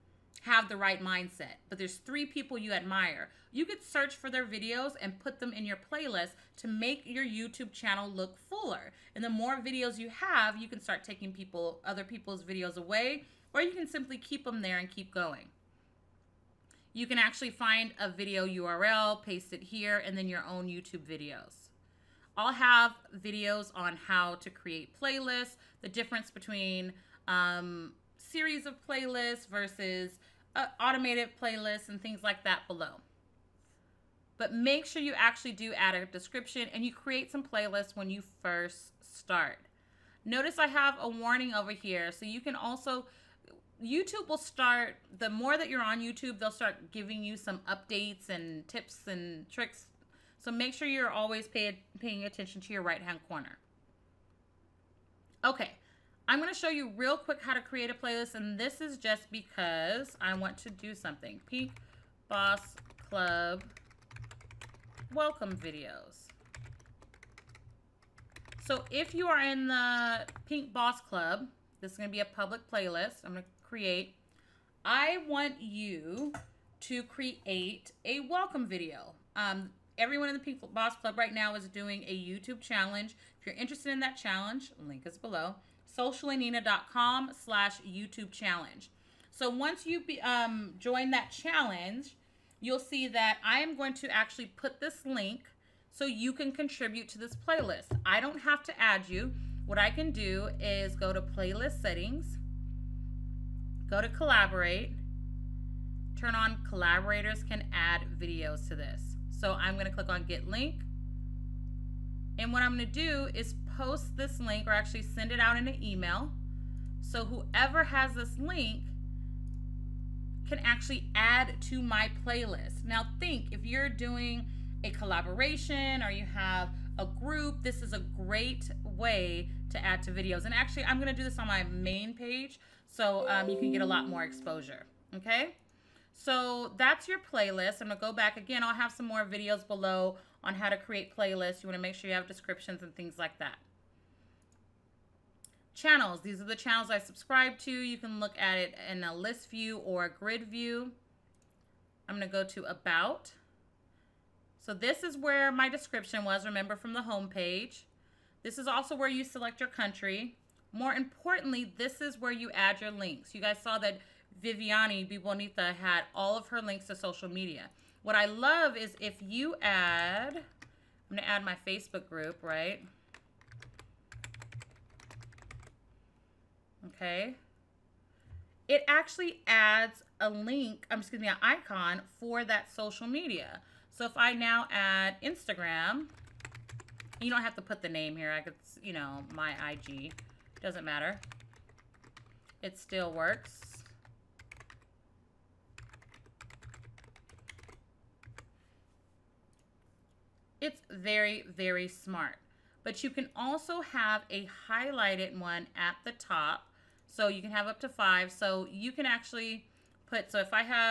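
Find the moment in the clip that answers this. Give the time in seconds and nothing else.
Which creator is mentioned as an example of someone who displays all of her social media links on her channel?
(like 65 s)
164 s.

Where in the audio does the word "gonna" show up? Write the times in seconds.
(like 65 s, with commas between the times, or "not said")
56 s, 130 s, 137 s.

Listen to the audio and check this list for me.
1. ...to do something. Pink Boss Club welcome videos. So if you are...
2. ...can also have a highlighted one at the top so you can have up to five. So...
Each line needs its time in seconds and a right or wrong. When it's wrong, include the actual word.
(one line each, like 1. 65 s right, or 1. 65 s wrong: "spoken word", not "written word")
1. 60 s right
2. 203 s right.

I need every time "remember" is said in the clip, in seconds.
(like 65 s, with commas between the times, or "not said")
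156 s.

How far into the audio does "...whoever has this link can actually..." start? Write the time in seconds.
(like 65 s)
117 s.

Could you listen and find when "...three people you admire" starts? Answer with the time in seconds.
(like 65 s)
1 s.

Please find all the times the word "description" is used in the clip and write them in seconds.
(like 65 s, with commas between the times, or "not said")
36 s, 142 s, 155 s.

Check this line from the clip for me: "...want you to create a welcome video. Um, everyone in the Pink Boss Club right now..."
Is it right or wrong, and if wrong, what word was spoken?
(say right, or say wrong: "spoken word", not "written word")
right.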